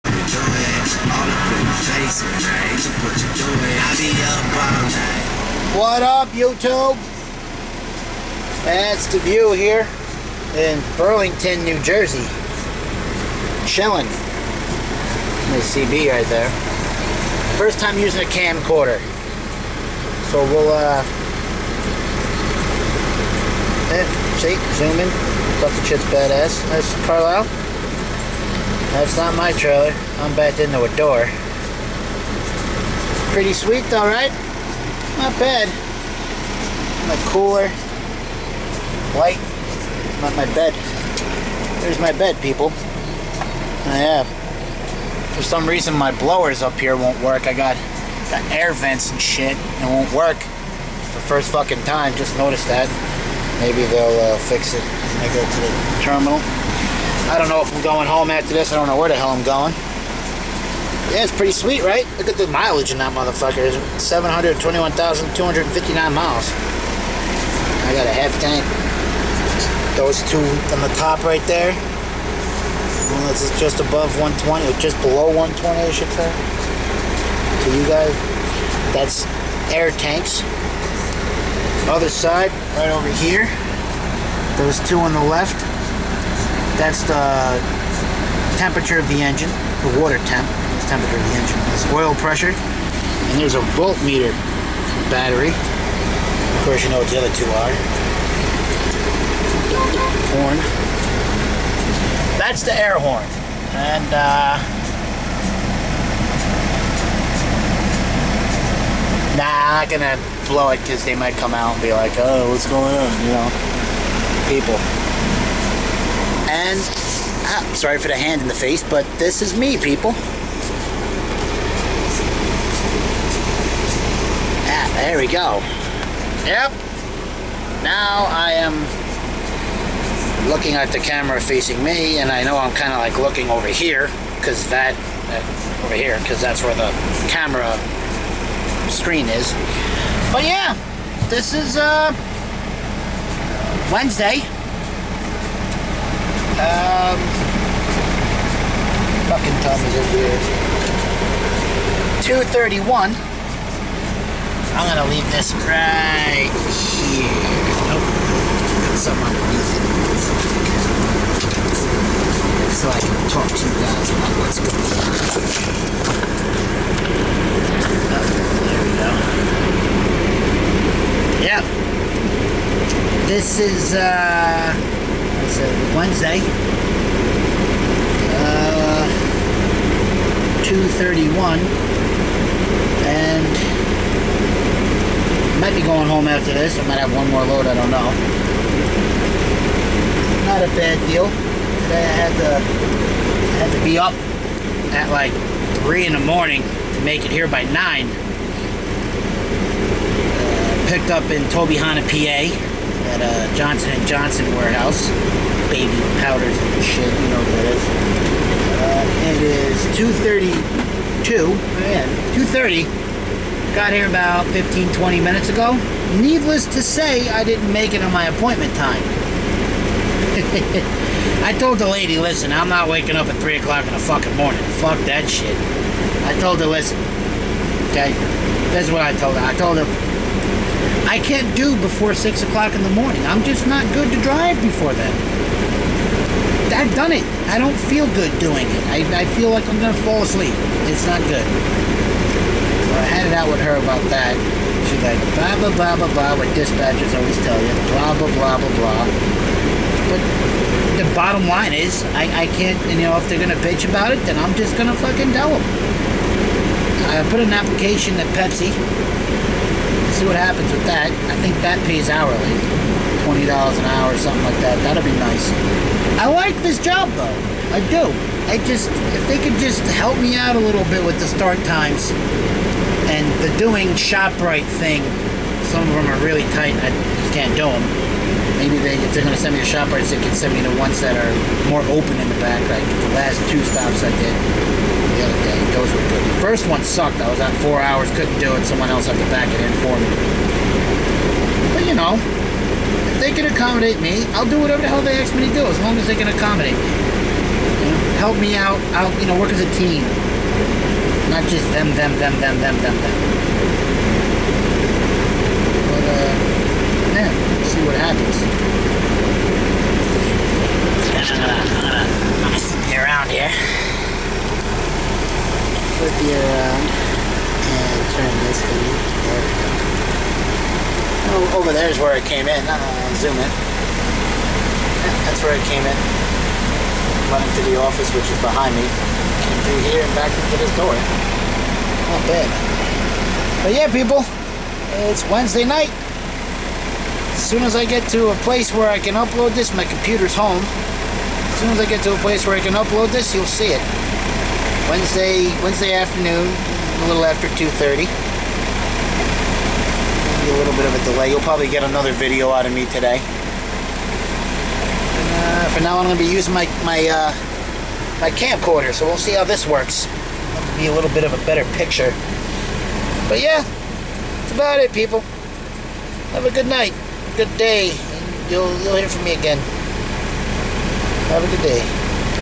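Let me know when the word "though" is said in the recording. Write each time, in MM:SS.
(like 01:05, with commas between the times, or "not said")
00:33, 04:27.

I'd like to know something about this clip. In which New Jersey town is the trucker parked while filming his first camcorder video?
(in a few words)
Burlington.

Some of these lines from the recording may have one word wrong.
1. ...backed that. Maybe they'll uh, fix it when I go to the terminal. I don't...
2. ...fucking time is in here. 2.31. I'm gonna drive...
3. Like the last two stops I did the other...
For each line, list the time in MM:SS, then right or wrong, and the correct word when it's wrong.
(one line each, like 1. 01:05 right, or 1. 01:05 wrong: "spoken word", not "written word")
1. 00:52 wrong: "noticed", not "backed"
2. 02:29 wrong: "leave", not "drive"
3. 04:42 right.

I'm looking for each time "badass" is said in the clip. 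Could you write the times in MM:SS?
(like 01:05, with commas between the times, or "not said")
00:26.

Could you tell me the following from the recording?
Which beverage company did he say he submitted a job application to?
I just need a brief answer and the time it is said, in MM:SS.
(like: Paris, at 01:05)
Pepsi, at 04:18.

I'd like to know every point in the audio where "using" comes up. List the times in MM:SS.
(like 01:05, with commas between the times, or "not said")
00:17, 05:56.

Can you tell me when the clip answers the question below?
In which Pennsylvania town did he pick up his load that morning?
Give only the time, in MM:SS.
03:21.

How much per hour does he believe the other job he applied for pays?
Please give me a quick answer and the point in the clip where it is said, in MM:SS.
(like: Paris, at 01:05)
$20 an hour, at 04:23.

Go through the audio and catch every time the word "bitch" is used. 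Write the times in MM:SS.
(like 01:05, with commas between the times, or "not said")
04:13.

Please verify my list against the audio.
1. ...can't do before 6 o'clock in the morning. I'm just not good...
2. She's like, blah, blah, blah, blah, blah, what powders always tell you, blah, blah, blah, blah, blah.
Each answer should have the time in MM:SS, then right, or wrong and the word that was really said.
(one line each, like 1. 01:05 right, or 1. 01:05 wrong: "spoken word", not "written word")
1. 03:51 right
2. 04:04 wrong: "dispatchers", not "powders".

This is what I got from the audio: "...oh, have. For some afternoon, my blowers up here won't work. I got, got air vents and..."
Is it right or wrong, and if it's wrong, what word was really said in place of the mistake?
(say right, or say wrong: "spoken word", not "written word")
wrong: "reason", not "afternoon".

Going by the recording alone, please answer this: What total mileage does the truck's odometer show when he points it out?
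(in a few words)
721,259 miles.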